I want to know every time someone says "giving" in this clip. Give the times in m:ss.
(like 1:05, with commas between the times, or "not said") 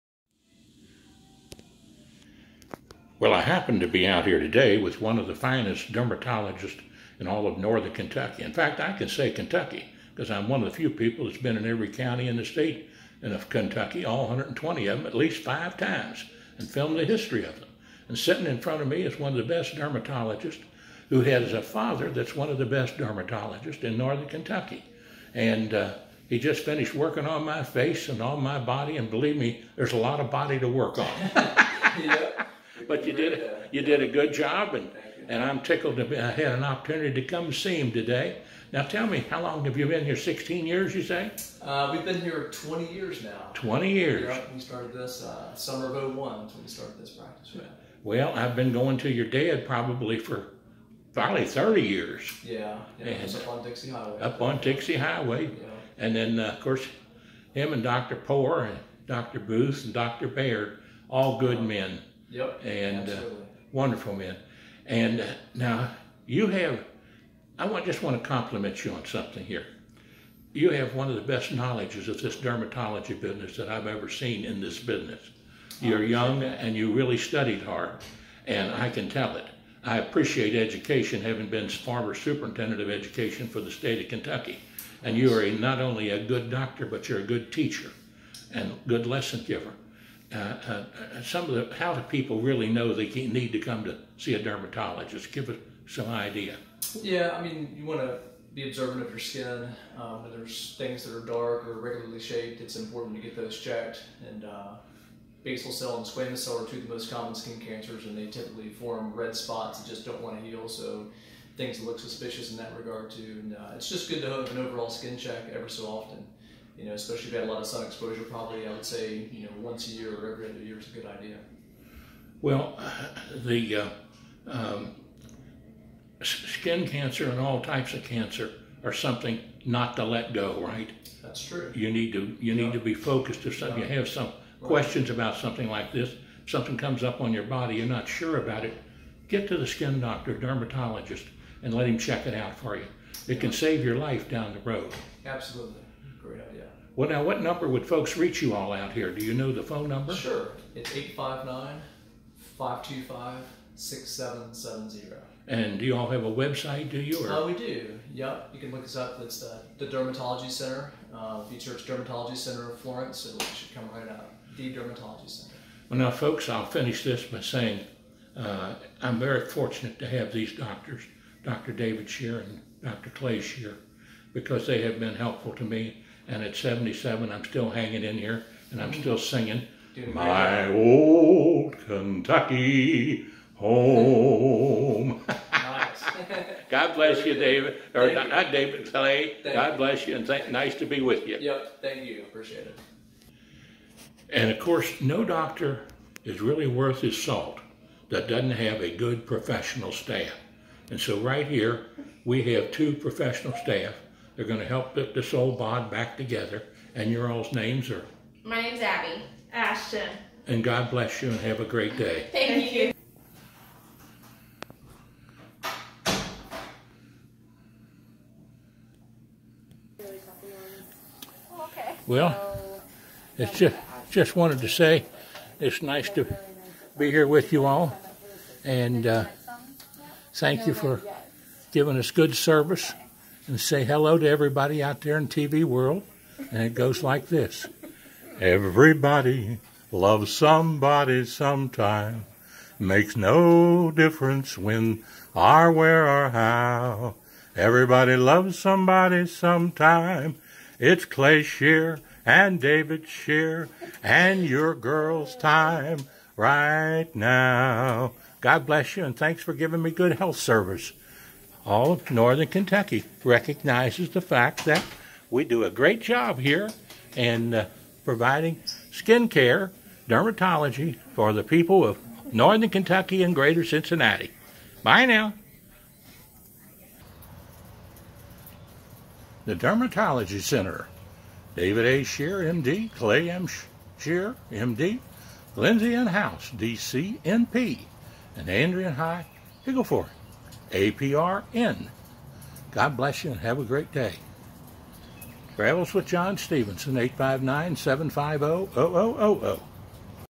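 3:51, 4:19.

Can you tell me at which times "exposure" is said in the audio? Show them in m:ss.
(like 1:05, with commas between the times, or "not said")
1:57.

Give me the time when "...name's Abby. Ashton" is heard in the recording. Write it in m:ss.
3:28.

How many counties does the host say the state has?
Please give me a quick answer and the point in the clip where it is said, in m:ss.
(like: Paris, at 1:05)
120, at 0:14.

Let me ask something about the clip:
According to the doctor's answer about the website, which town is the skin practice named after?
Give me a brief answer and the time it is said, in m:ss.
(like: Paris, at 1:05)
Florence, at 2:42.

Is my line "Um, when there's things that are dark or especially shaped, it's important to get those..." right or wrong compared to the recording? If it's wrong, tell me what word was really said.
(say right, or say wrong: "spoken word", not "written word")
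wrong: "irregularly", not "especially".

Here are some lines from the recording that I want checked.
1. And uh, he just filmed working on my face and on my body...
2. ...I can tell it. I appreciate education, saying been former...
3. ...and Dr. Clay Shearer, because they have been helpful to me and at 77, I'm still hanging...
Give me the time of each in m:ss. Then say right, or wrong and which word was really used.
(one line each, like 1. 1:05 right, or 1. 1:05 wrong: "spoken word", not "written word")
1. 0:25 wrong: "finished", not "filmed"
2. 1:18 wrong: "having", not "saying"
3. 2:52 right.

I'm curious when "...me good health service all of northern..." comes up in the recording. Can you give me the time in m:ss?
4:19.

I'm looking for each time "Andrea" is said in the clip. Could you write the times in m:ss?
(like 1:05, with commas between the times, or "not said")
4:48.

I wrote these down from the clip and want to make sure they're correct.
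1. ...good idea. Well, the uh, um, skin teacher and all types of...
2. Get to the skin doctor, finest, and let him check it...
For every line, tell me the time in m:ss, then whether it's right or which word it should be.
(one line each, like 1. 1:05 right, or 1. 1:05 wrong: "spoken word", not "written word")
1. 2:00 wrong: "cancer", not "teacher"
2. 2:19 wrong: "dermatologist", not "finest".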